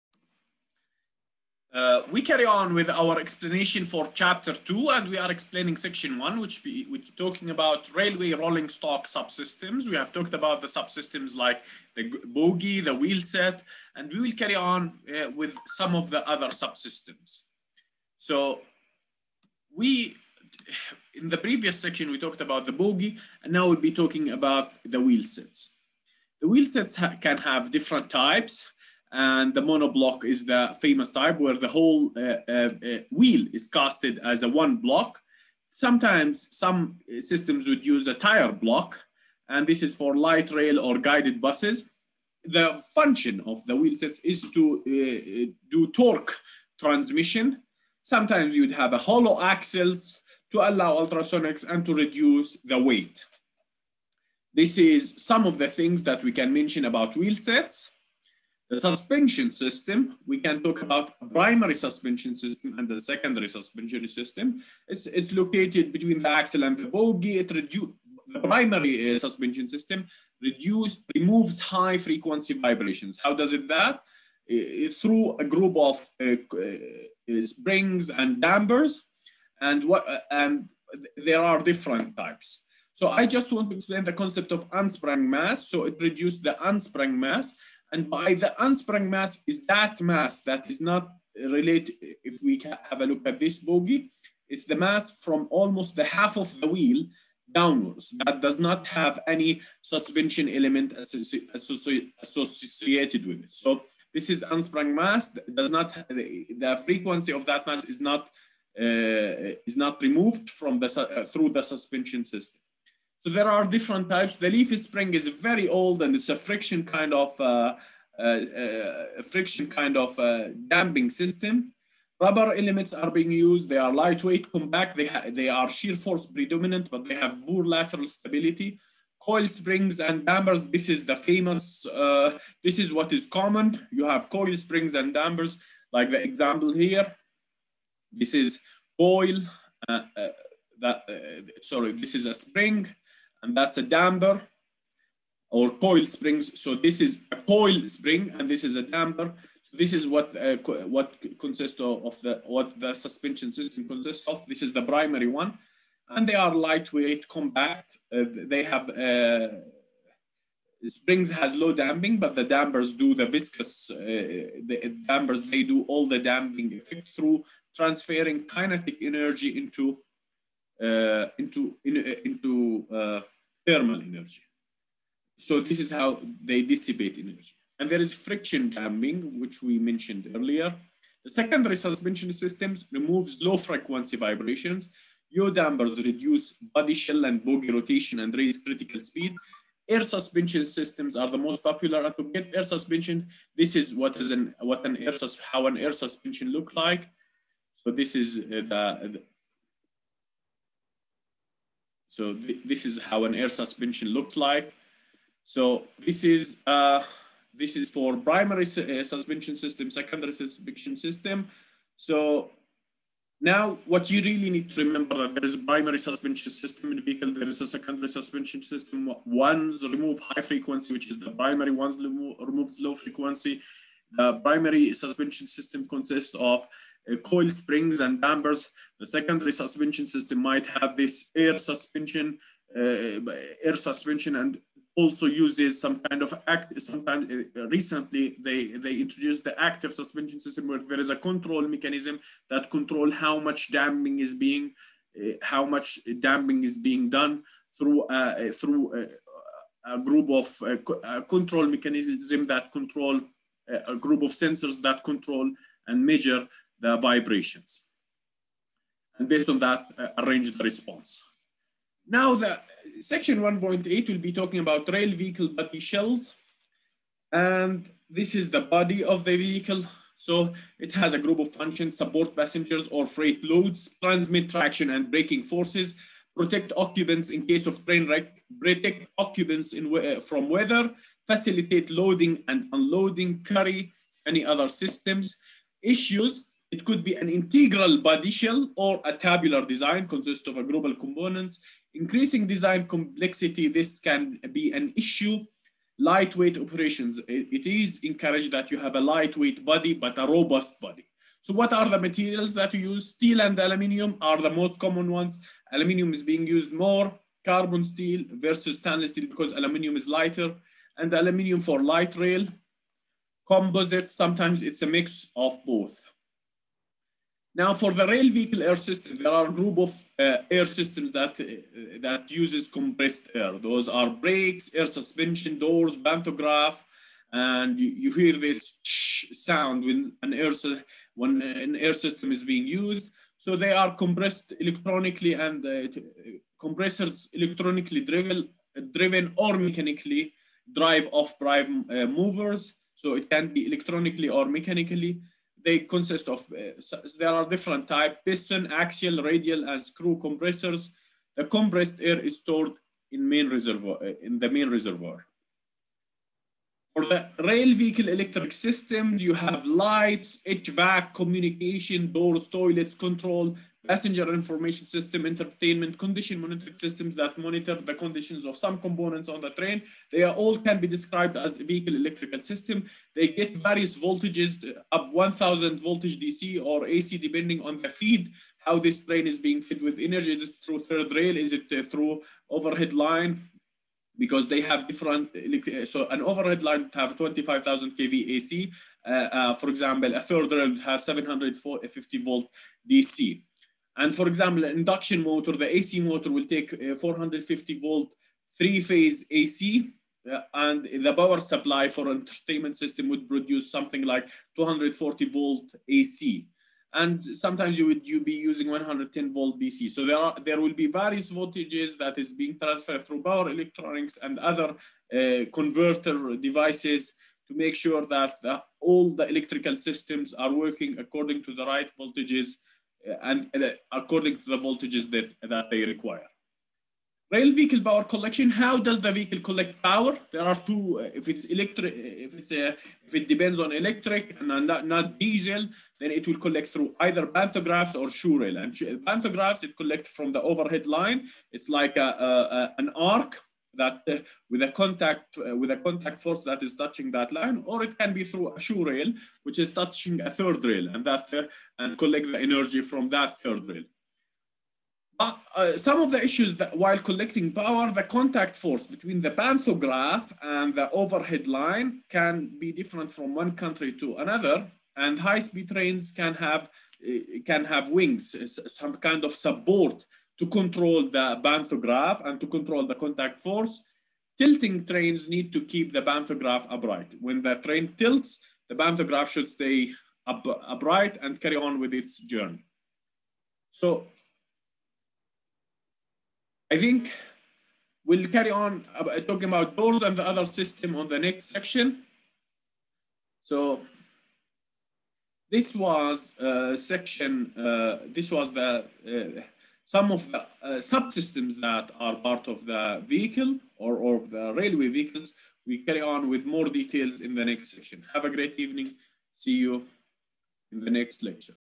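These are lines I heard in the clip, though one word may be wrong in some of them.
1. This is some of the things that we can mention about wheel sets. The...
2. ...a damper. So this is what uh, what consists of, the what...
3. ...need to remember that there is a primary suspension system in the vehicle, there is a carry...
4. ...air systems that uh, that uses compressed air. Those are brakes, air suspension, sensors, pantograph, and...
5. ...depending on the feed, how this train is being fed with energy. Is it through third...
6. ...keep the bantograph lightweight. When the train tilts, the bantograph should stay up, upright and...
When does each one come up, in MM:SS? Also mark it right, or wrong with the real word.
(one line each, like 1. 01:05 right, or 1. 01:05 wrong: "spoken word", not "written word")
1. 00:54 right
2. 02:28 right
3. 03:34 wrong: "secondary", not "carry"
4. 05:20 wrong: "doors", not "sensors"
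5. 06:17 right
6. 07:55 wrong: "upright", not "lightweight".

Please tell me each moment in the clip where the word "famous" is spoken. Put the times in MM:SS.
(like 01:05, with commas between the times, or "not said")
00:30, 02:11.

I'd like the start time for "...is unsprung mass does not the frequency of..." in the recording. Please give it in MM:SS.
01:44.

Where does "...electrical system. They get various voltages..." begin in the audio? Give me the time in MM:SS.
06:11.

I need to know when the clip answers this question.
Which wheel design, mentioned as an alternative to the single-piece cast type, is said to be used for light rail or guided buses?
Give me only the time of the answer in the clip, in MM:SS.
00:38.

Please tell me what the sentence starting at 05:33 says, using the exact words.
So they are compressed electronically, and uh, compressors electronically driven, driven or mechanically drive off prime uh, movers.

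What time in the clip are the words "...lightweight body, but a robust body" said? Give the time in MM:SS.
04:59.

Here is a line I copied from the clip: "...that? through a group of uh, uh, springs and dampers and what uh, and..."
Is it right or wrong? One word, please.
right.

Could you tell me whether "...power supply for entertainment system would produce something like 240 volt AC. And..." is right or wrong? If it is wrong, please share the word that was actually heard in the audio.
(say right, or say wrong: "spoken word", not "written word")
right.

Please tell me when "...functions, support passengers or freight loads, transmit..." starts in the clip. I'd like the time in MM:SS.
04:31.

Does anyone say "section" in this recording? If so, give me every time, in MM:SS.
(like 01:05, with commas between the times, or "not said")
00:05, 00:21, 04:22, 08:11, 08:16, 08:27.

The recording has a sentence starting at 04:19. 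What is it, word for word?
And based on that, uh, arrange the response.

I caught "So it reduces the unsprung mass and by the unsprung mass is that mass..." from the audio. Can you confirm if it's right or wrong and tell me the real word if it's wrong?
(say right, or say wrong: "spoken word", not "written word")
right.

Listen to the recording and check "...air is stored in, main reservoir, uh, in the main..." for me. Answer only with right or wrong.
right.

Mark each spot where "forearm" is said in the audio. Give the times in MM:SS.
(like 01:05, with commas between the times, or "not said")
not said.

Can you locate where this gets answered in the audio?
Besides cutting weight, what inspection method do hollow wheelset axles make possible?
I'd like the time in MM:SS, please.
00:51.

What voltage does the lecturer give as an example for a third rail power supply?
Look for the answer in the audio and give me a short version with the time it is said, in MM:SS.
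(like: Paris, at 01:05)
750 volt DC, at 06:31.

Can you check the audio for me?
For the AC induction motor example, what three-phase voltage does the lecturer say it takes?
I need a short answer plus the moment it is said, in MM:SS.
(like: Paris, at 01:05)
450 volt, at 06:36.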